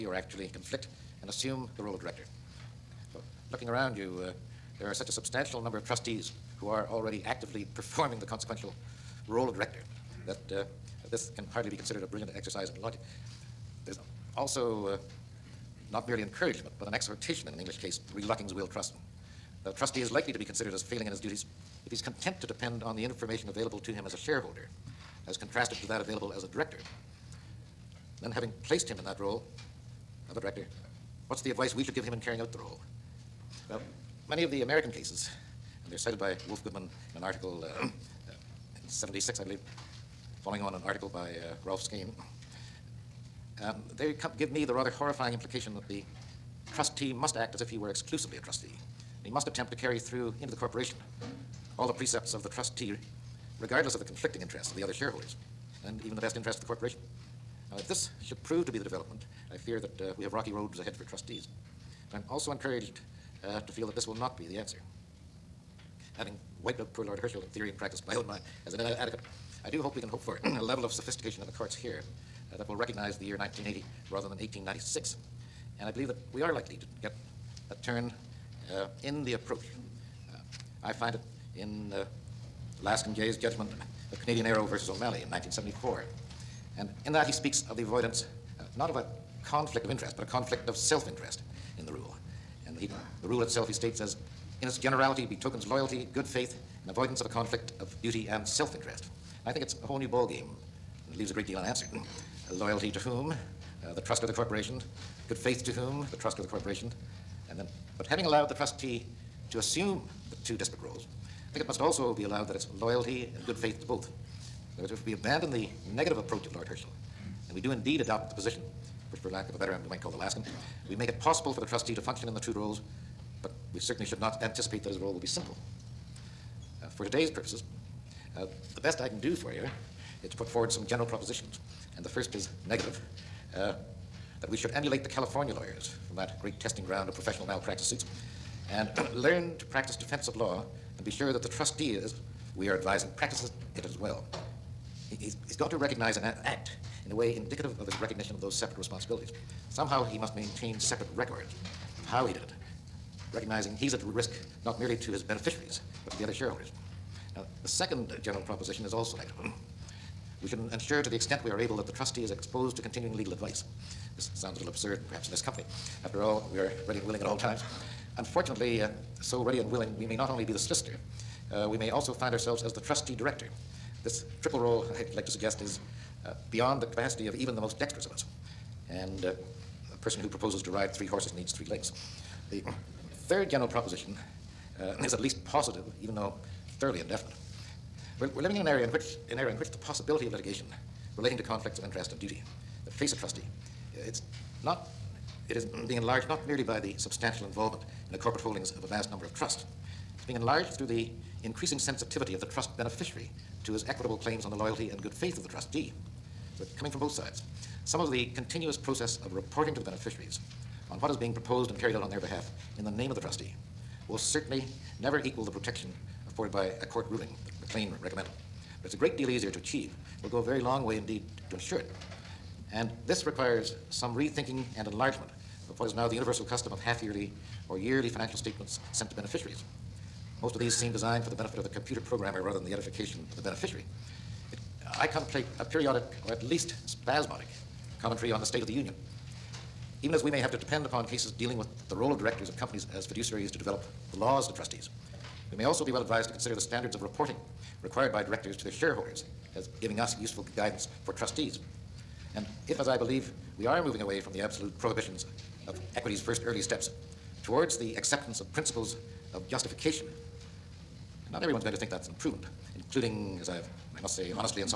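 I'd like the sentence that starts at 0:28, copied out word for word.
Then having placed him in that role of a director, what's the advice we should give him in carrying out the role?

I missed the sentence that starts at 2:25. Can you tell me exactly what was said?
He's, he's got to recognize and act in a way indicative of his recognition of those separate responsibilities.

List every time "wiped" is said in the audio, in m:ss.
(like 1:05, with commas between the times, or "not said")
1:06.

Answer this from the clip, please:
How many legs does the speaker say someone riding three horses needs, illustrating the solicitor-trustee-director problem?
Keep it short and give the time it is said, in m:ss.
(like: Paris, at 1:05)
3, at 3:01.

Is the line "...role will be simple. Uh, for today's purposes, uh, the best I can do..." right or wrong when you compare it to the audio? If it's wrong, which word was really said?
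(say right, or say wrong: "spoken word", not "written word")
right.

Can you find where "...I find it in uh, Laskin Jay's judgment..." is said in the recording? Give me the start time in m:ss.
1:20.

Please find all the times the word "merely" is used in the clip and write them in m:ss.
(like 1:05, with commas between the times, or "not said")
0:16, 2:34, 3:16.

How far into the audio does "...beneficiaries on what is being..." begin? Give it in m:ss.
3:29.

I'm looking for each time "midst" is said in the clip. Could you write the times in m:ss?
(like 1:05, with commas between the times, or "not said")
not said.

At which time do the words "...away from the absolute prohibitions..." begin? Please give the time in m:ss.
4:14.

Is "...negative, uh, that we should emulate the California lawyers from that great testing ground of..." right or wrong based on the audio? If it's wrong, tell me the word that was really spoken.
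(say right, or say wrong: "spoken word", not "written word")
right.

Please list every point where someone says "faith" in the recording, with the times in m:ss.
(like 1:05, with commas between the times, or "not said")
1:36, 1:45, 1:53, 3:25.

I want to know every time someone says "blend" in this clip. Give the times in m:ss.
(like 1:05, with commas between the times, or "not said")
not said.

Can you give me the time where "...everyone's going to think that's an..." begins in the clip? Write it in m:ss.
4:21.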